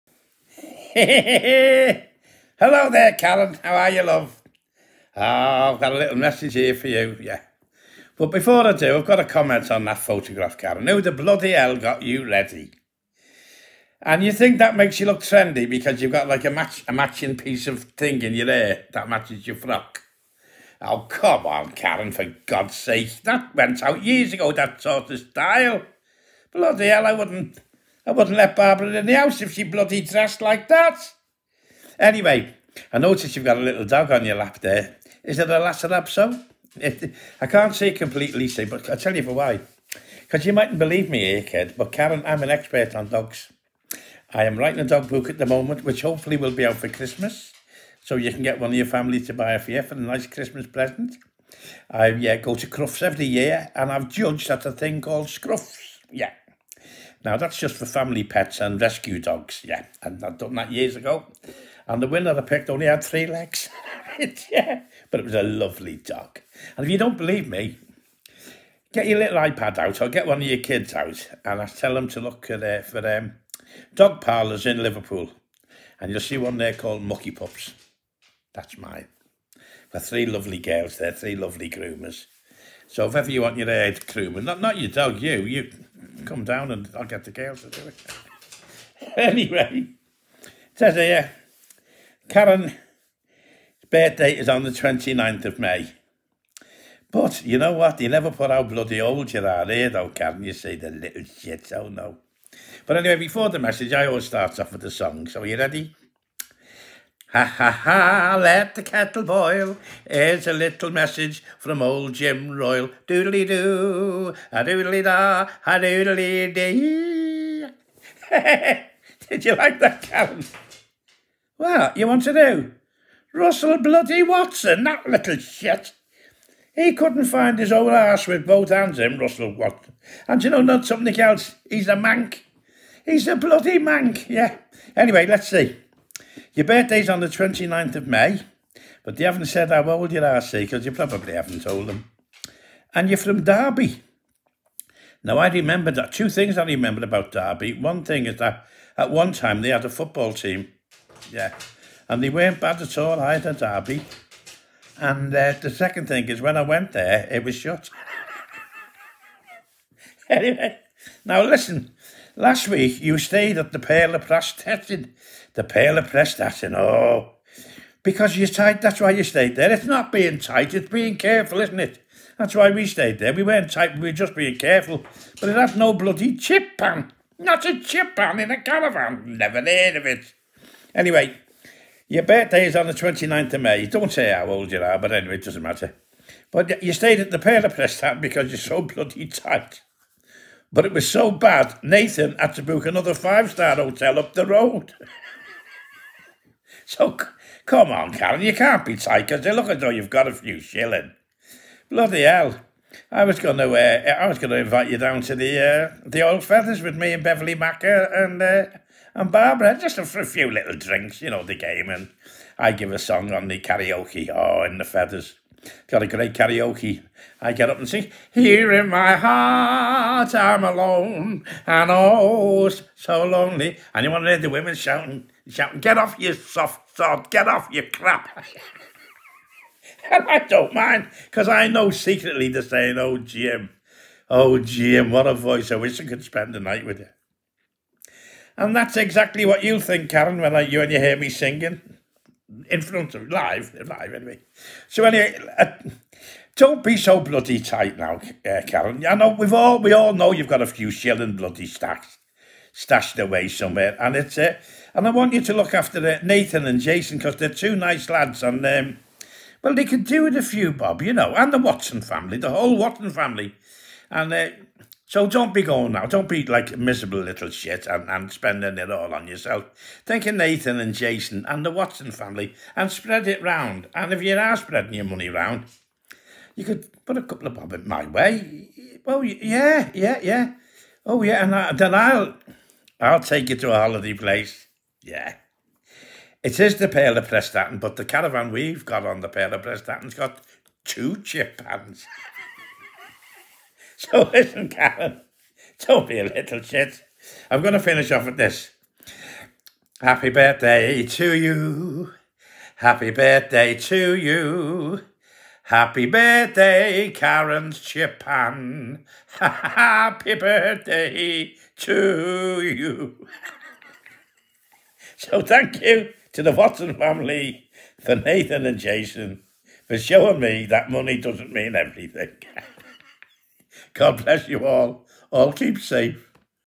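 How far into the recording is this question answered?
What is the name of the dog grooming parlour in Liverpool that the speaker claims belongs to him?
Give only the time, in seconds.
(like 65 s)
77 s.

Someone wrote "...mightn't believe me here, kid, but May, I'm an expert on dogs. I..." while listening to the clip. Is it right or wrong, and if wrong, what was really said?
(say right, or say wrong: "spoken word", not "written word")
wrong: "Karen", not "May".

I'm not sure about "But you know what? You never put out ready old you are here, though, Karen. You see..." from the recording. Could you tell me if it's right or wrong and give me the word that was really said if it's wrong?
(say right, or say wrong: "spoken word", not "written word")
wrong: "bloody", not "ready".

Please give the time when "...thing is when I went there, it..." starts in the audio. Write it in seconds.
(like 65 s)
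156 s.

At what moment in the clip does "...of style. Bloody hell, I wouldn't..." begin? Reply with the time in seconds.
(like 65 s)
25 s.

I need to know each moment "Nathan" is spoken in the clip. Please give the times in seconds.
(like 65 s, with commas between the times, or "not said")
191 s, 256 s, 270 s, 318 s.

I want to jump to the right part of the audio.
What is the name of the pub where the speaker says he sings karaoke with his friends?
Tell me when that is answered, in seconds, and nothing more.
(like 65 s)
206 s.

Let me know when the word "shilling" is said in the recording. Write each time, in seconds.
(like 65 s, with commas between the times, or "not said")
200 s, 250 s.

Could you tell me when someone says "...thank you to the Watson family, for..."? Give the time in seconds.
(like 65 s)
315 s.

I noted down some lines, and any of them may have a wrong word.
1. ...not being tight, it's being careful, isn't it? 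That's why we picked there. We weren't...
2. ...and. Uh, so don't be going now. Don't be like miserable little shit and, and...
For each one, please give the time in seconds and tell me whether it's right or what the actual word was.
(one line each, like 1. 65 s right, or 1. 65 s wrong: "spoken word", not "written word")
1. 169 s wrong: "stayed", not "picked"
2. 264 s right.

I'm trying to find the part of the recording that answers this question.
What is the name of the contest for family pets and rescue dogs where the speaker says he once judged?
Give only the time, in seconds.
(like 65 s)
55 s.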